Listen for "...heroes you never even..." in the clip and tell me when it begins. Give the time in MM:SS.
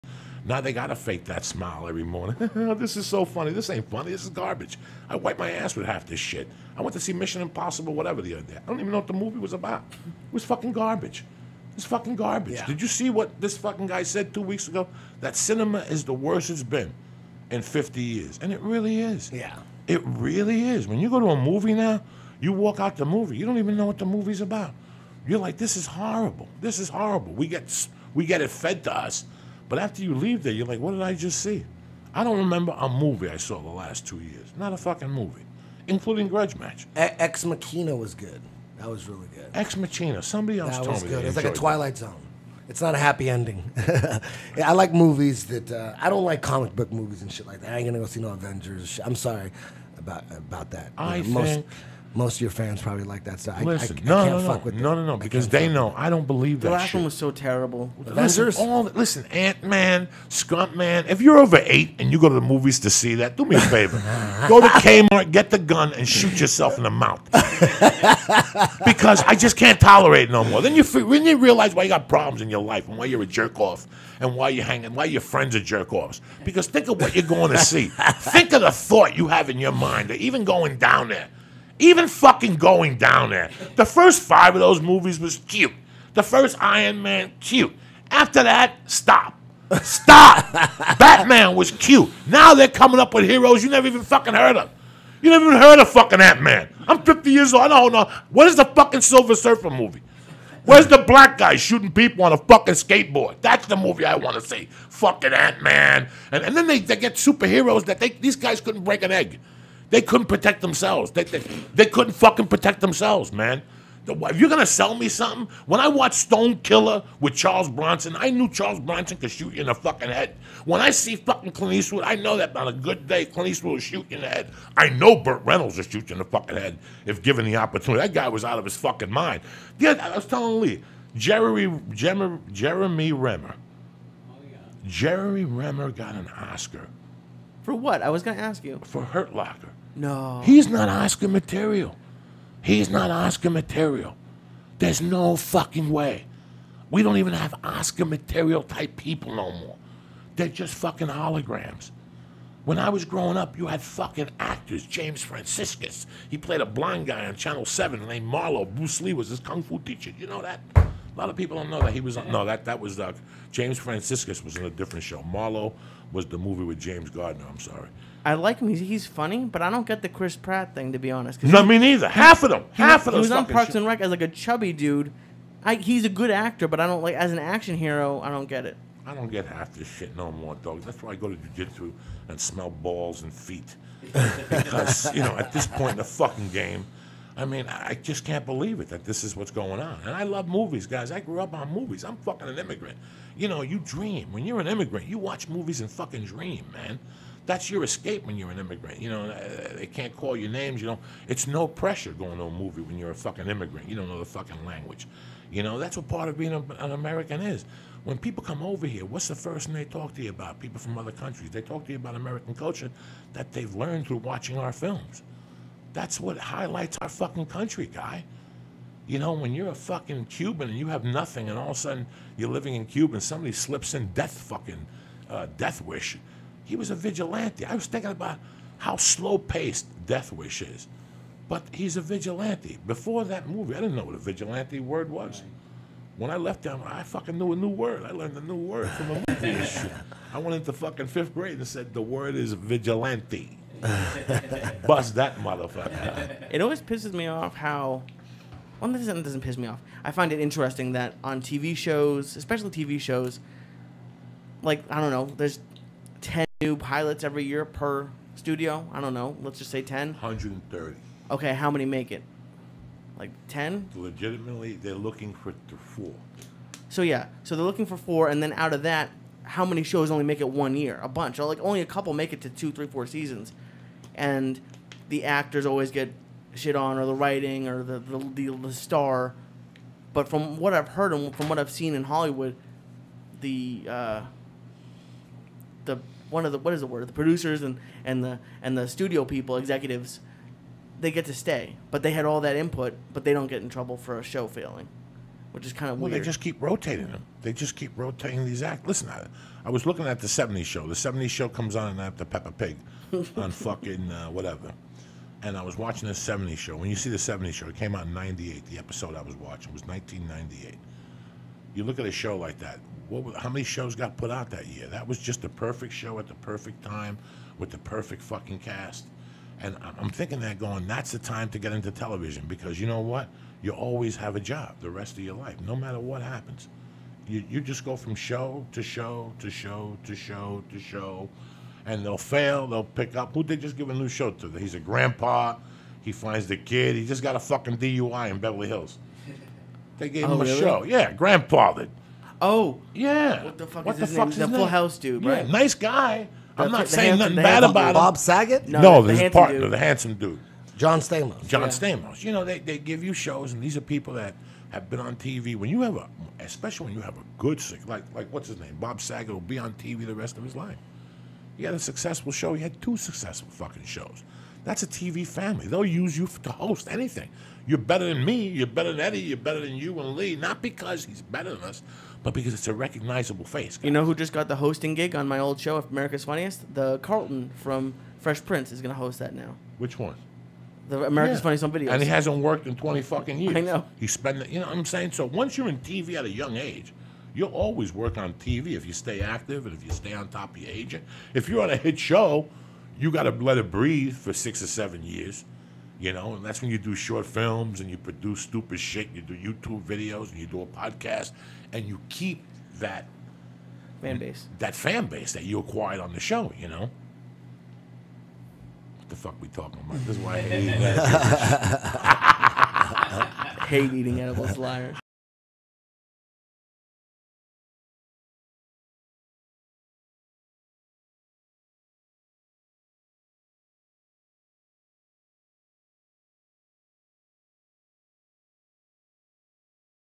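01:33.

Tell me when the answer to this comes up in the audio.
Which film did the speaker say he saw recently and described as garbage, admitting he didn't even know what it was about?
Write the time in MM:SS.
00:07.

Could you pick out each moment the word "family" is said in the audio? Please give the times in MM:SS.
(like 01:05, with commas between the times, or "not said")
06:05.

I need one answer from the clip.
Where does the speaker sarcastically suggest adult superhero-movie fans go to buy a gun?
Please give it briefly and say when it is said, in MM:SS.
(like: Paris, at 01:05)
Kmart, at 01:04.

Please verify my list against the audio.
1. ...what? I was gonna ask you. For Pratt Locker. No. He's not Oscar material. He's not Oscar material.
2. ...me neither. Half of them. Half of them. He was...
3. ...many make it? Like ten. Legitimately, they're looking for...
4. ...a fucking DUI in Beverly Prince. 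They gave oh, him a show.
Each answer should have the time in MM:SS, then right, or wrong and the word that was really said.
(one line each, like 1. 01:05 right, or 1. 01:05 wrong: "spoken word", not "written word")
1. 02:17 wrong: "Hurt", not "Pratt"
2. 02:51 right
3. 04:21 right
4. 05:37 wrong: "Hills", not "Prince".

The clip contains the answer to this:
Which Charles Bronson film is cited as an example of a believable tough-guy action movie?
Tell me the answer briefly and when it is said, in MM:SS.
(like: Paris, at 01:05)
Stone Killer, at 01:56.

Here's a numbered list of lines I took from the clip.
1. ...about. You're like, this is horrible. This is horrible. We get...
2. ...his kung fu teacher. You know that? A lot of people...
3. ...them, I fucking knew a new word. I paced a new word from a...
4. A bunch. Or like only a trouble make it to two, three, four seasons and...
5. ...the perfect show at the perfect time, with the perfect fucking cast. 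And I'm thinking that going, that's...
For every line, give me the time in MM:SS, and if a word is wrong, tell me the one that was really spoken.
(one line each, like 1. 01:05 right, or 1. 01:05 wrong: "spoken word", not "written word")
1. 00:24 right
2. 02:39 right
3. 03:56 wrong: "learned", not "paced"
4. 04:31 wrong: "couple", not "trouble"
5. 05:15 right.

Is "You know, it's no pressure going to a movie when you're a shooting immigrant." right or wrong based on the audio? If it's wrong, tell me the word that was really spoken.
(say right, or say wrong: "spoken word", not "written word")
wrong: "fucking", not "shooting".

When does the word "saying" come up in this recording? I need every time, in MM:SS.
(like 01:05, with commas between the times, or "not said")
05:46, 06:24.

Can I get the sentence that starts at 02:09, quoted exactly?
Yeah, I was telling Lee, Jeremy Jeremy, Jeremy Renner.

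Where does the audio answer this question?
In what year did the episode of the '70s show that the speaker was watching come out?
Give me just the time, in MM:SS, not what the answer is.
05:09.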